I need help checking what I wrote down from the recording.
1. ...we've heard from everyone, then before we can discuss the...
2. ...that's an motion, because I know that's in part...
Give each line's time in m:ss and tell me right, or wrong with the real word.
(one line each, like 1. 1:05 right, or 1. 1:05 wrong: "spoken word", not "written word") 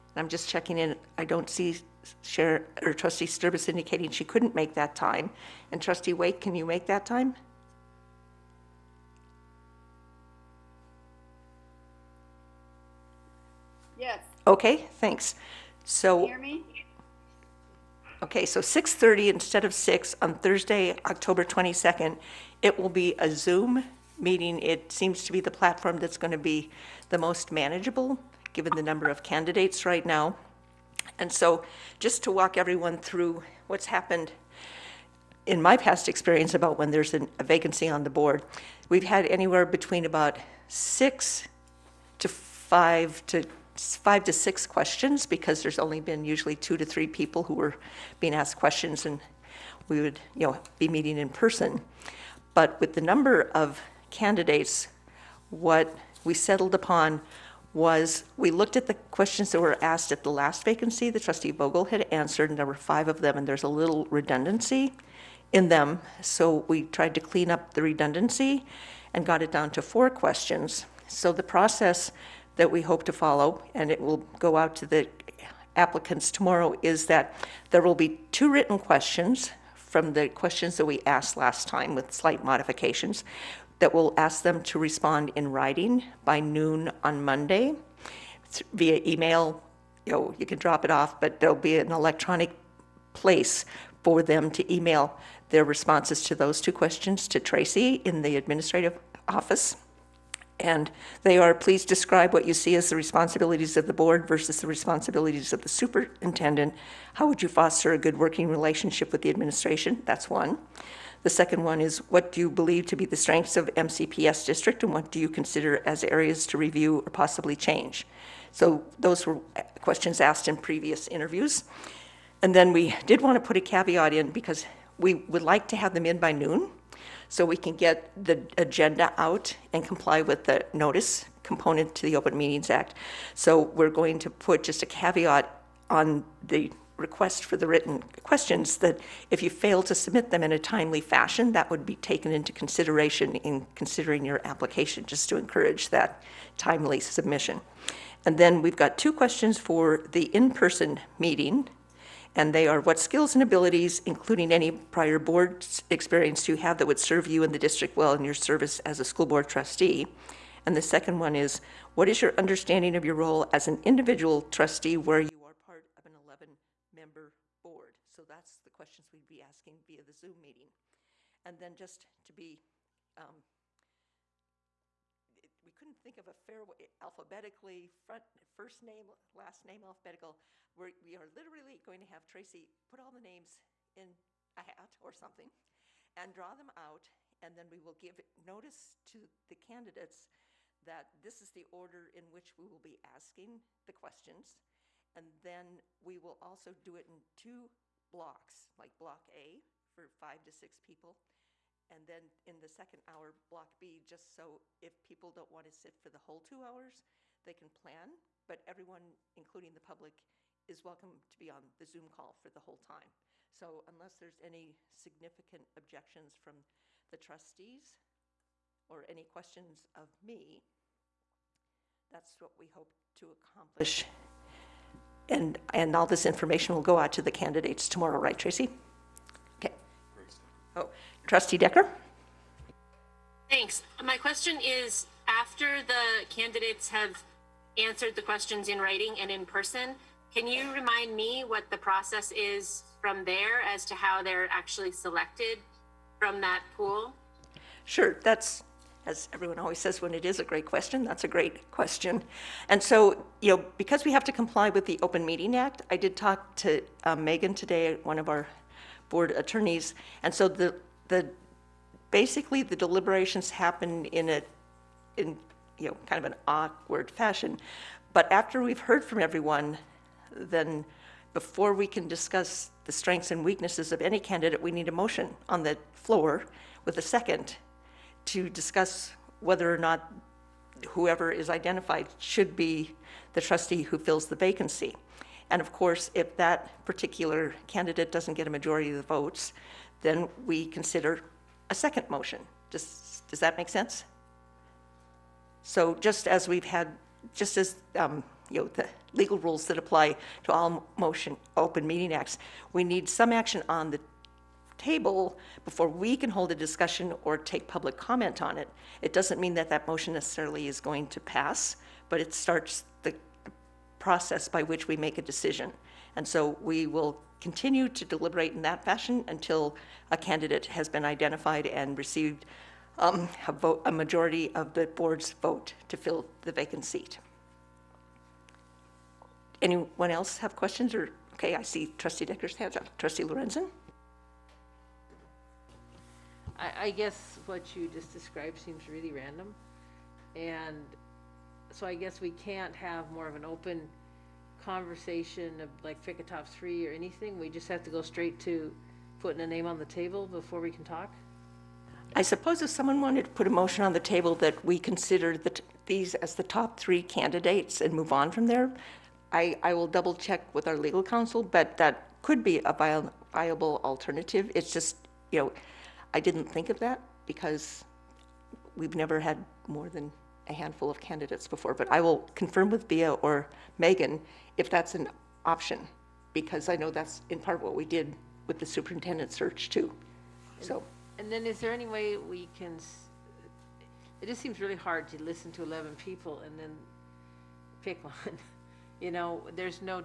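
1. 4:28 right
2. 6:14 wrong: "option", not "motion".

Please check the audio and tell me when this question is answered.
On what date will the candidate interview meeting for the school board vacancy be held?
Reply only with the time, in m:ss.
0:20.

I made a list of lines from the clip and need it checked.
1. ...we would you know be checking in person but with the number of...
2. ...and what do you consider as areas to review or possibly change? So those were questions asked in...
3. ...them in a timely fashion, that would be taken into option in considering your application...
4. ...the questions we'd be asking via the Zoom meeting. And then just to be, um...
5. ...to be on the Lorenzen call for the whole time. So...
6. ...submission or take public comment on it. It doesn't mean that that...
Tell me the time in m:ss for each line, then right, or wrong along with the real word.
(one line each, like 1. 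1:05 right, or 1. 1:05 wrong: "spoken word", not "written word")
1. 0:49 wrong: "meeting", not "checking"
2. 1:54 right
3. 2:20 wrong: "consideration", not "option"
4. 2:48 right
5. 3:31 wrong: "Zoom", not "Lorenzen"
6. 5:06 wrong: "discussion", not "submission".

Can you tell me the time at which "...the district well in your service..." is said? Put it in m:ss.
2:37.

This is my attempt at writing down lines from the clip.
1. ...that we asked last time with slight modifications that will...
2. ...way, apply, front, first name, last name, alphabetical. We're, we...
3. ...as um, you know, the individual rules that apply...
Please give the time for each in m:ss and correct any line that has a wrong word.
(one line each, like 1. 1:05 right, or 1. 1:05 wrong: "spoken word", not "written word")
1. 1:20 right
2. 2:56 wrong: "alphabetically", not "apply"
3. 4:57 wrong: "legal", not "individual".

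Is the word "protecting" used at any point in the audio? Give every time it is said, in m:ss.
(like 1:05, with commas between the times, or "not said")
not said.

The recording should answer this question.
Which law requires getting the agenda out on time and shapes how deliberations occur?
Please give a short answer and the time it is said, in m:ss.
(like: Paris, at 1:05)
Open Meetings Act, at 2:12.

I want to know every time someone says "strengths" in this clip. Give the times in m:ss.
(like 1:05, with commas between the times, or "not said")
1:53, 4:32.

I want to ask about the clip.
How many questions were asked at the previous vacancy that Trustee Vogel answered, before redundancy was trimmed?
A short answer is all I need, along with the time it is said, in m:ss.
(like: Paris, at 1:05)
5, at 1:02.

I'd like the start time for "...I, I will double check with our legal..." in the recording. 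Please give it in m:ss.
5:59.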